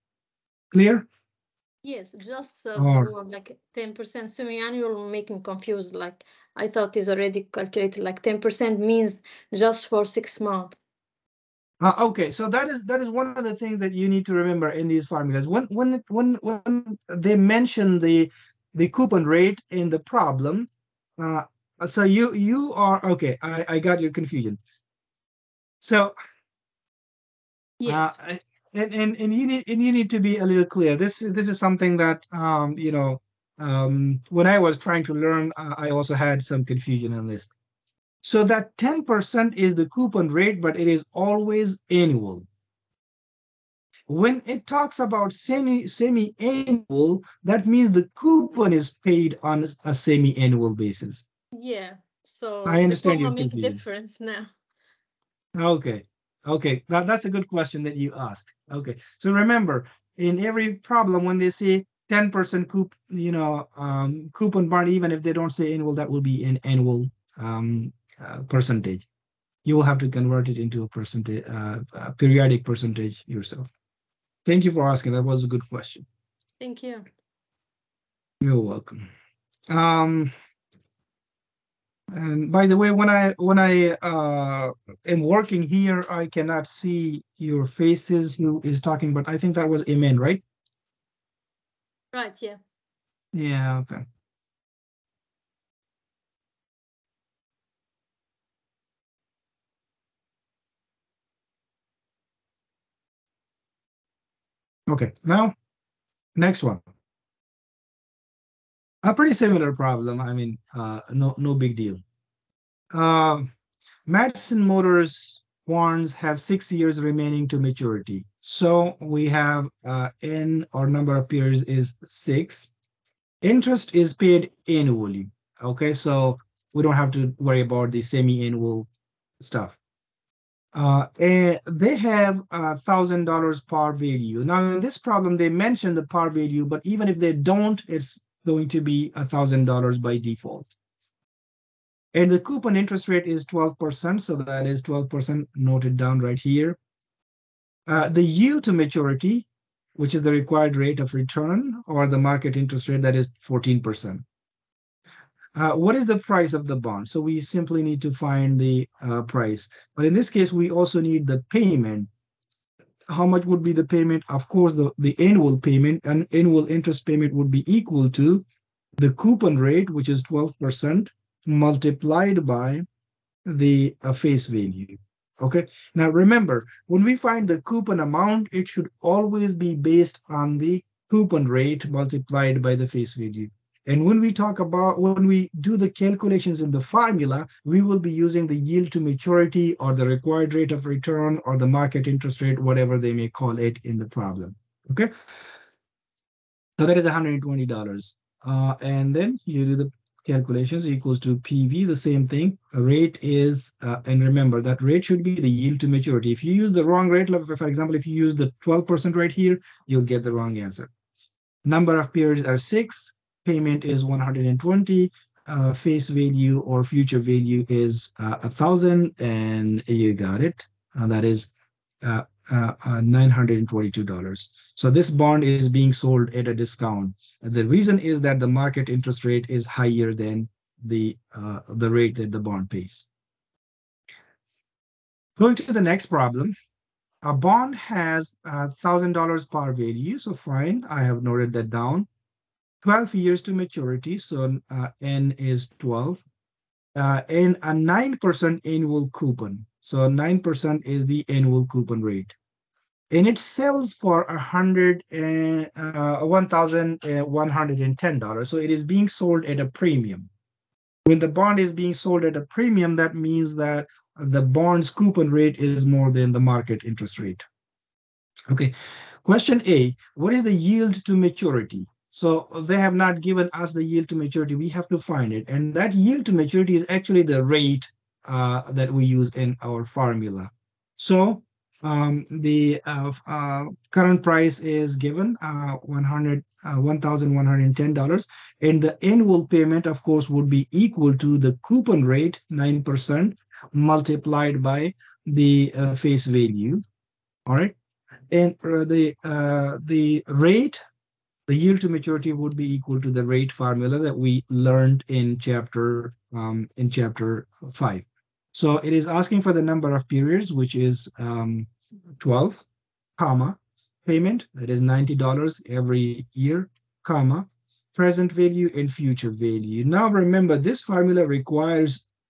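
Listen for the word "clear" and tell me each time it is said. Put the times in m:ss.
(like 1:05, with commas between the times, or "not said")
0:00, 0:30.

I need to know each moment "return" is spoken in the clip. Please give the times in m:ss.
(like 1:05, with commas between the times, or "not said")
2:31, 3:10.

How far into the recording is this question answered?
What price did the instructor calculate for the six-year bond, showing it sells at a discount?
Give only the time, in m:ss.
3:43.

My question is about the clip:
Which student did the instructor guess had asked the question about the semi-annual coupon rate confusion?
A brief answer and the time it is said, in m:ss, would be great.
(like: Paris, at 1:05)
Imen, at 1:29.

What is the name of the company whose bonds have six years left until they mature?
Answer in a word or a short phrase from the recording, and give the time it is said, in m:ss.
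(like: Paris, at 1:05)
Madison Motors, at 1:54.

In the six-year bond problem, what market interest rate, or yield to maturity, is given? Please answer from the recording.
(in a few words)
14%.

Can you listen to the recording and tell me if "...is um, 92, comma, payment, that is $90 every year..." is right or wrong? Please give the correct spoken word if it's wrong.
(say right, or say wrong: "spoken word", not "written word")
wrong: "12", not "92".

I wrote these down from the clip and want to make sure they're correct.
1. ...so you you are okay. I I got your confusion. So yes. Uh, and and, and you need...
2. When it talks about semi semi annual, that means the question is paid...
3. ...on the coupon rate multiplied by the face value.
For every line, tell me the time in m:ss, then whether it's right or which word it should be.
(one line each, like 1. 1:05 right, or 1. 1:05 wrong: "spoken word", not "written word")
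1. 0:21 right
2. 0:44 wrong: "coupon", not "question"
3. 3:00 right.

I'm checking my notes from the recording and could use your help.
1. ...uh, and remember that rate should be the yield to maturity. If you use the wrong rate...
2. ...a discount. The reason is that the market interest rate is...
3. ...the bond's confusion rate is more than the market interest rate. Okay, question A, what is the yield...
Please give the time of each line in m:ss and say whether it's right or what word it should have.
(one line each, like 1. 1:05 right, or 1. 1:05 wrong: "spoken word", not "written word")
1. 3:23 right
2. 3:46 right
3. 4:24 wrong: "coupon", not "confusion".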